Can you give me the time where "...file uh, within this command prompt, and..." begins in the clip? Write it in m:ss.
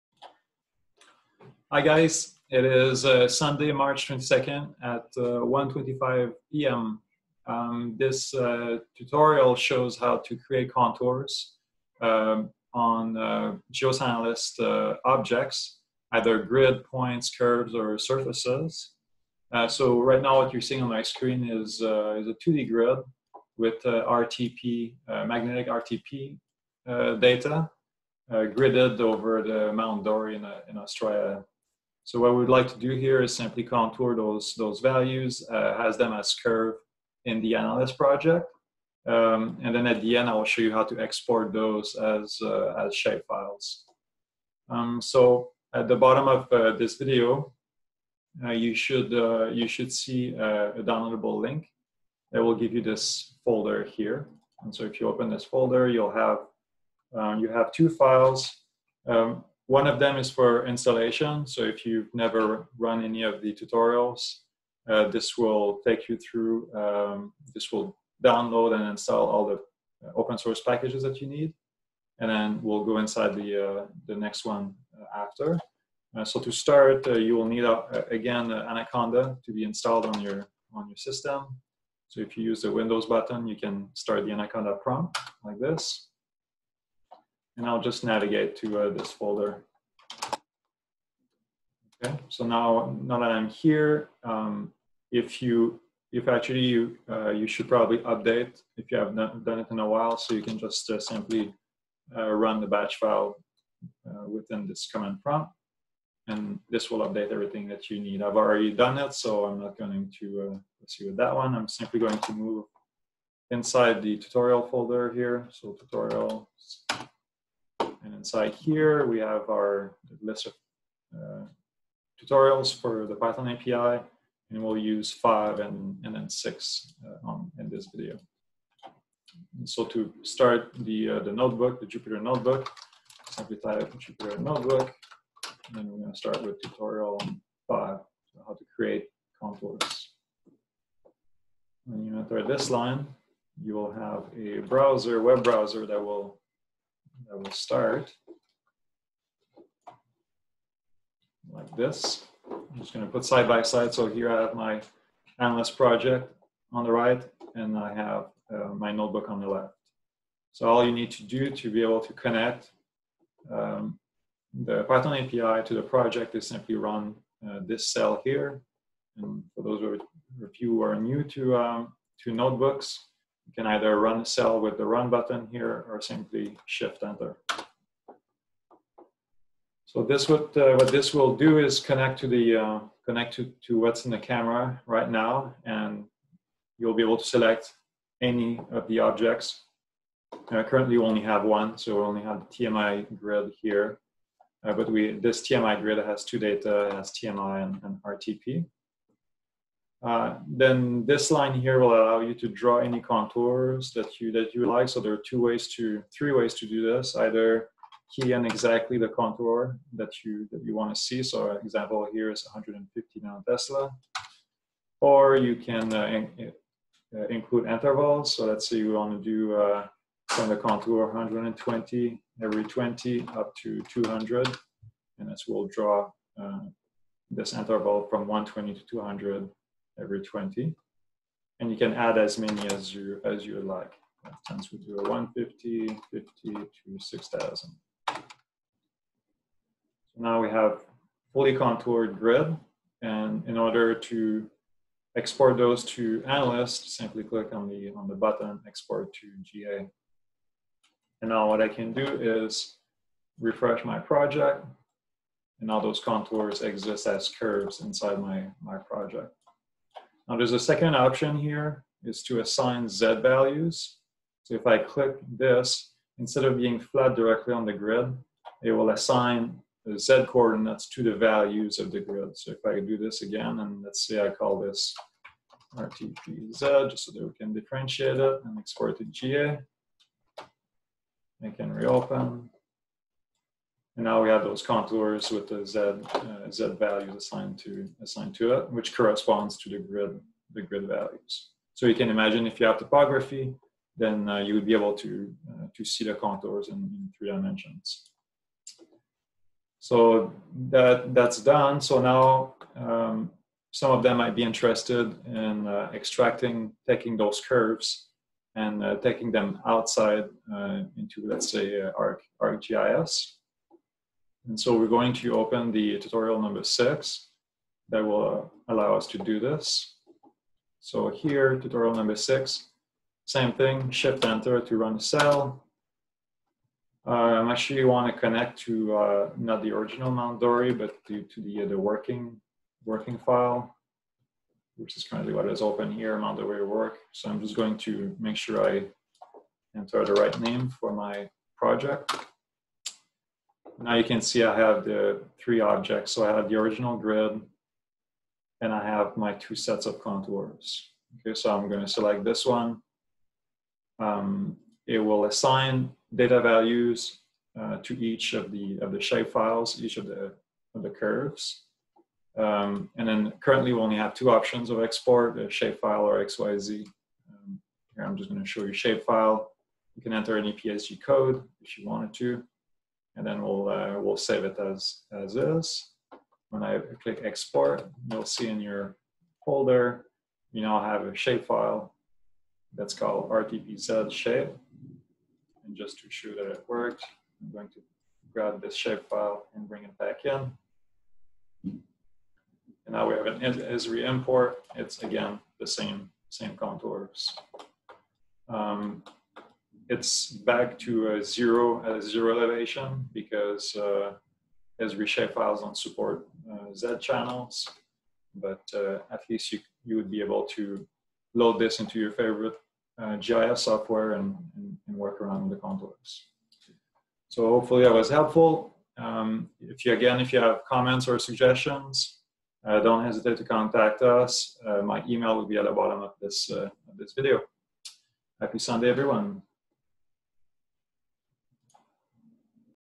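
1:42.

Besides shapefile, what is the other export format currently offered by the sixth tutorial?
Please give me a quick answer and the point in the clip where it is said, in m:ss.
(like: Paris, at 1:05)
XYZ, at 6:06.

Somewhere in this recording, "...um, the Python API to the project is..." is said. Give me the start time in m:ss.
2:43.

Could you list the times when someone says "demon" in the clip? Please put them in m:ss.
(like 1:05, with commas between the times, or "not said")
not said.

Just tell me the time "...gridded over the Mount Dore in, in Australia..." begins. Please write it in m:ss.
0:28.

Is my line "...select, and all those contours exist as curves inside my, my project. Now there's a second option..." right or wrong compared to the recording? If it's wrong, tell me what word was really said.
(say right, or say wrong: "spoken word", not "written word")
wrong: "project", not "select".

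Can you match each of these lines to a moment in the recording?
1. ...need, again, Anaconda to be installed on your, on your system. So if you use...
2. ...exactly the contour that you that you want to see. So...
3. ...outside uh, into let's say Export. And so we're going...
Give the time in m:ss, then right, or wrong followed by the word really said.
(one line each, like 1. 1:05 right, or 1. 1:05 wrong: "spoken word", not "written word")
1. 1:17 right
2. 3:28 right
3. 5:09 wrong: "ArcGIS", not "Export".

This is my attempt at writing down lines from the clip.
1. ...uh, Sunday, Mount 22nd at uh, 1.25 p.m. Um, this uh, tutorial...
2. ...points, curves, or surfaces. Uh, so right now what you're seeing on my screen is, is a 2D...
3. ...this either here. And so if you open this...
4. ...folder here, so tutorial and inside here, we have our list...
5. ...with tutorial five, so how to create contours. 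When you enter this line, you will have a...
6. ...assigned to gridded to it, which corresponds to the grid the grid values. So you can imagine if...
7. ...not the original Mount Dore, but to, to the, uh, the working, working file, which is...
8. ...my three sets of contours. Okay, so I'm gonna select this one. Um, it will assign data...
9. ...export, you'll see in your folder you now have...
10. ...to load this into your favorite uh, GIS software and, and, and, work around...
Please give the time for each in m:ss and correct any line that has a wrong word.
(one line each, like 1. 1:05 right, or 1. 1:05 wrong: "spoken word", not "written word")
1. 0:03 wrong: "March", not "Mount"
2. 0:16 right
3. 0:52 wrong: "folder", not "either"
4. 1:54 right
5. 2:16 right
6. 4:47 wrong: "assigned", not "gridded"
7. 5:29 right
8. 5:49 wrong: "two", not "three"
9. 6:17 right
10. 6:50 right.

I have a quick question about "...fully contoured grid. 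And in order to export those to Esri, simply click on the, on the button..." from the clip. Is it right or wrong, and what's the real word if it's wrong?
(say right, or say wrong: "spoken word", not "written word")
wrong: "Analyst", not "Esri".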